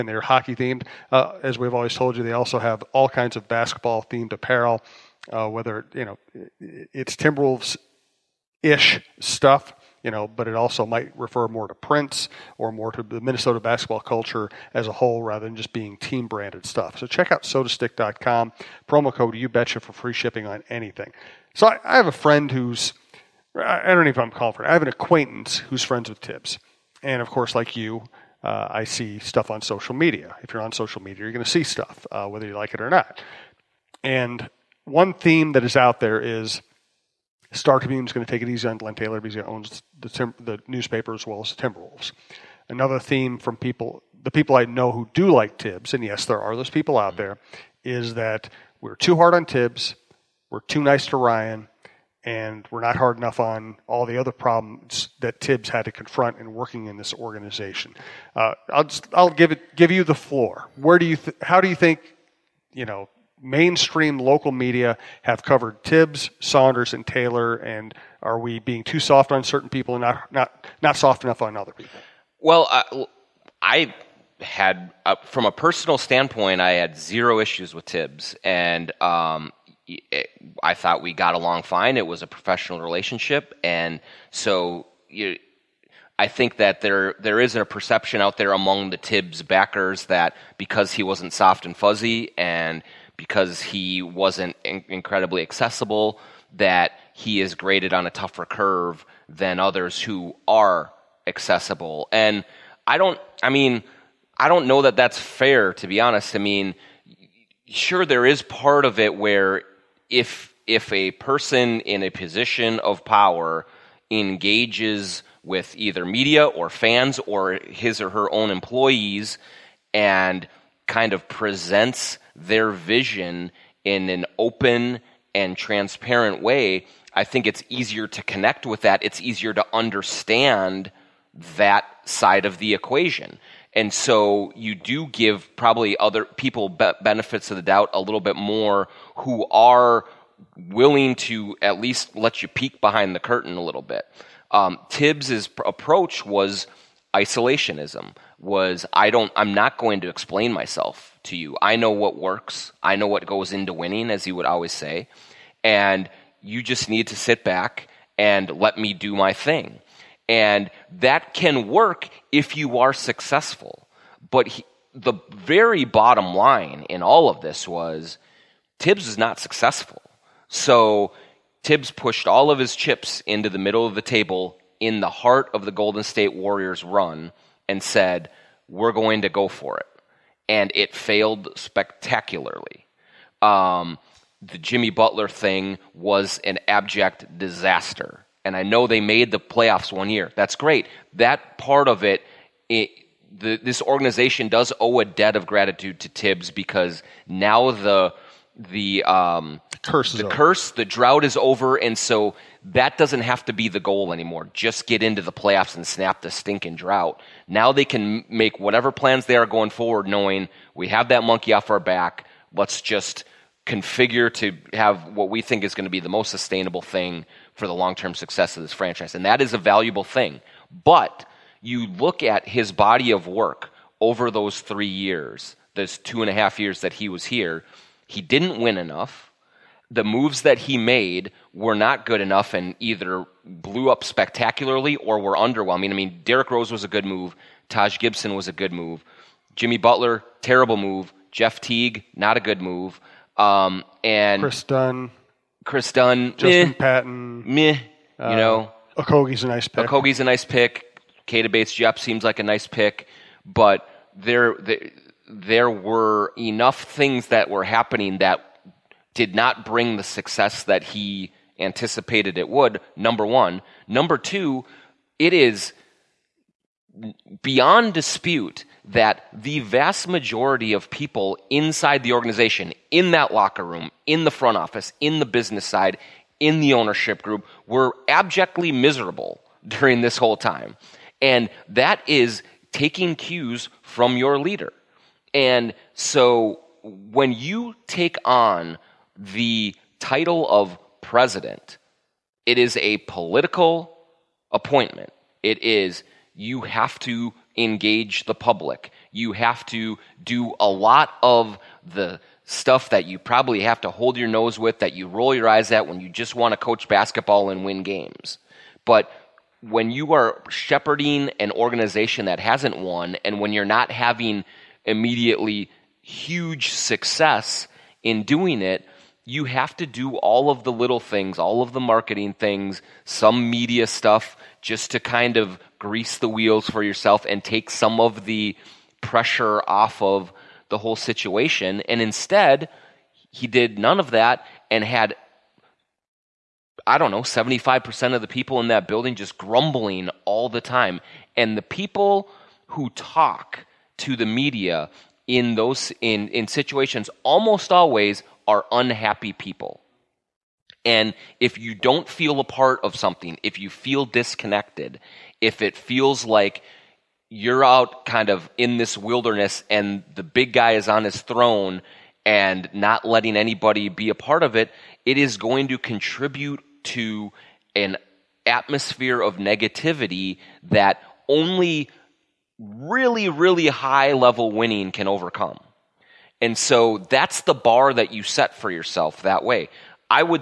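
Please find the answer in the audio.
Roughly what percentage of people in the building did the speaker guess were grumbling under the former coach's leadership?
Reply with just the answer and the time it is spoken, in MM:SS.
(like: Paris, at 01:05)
75%, at 05:37.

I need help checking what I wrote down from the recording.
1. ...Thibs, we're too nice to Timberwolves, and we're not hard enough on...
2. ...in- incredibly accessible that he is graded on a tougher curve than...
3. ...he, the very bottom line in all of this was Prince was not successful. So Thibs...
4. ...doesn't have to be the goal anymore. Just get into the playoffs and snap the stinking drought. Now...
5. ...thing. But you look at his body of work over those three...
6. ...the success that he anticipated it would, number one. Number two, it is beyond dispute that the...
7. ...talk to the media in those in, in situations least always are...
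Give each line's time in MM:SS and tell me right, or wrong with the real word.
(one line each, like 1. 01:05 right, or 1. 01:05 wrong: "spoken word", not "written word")
1. 00:49 wrong: "Ryan", not "Timberwolves"
2. 01:34 right
3. 02:44 wrong: "Thibs", not "Prince"
4. 03:22 right
5. 03:40 right
6. 04:19 right
7. 05:42 wrong: "almost", not "least".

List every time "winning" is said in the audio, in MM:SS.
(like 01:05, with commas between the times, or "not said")
02:33, 06:14.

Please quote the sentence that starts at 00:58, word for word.
Uh, I'll just, I'll give it give you the floor.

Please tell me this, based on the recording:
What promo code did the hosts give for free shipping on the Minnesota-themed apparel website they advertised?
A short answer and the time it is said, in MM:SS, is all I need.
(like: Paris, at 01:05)
you betcha, at 00:19.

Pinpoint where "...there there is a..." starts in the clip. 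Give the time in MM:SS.
01:26.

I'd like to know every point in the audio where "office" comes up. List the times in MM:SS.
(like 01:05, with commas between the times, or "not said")
04:34.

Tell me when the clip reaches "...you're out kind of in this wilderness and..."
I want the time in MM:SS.
05:57.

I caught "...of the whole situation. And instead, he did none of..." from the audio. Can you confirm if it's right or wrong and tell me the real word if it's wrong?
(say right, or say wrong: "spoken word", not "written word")
right.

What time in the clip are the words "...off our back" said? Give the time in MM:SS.
03:31.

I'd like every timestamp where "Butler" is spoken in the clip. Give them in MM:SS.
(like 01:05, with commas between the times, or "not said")
03:04, 03:59.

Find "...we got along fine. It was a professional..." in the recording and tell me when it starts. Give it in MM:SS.
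01:21.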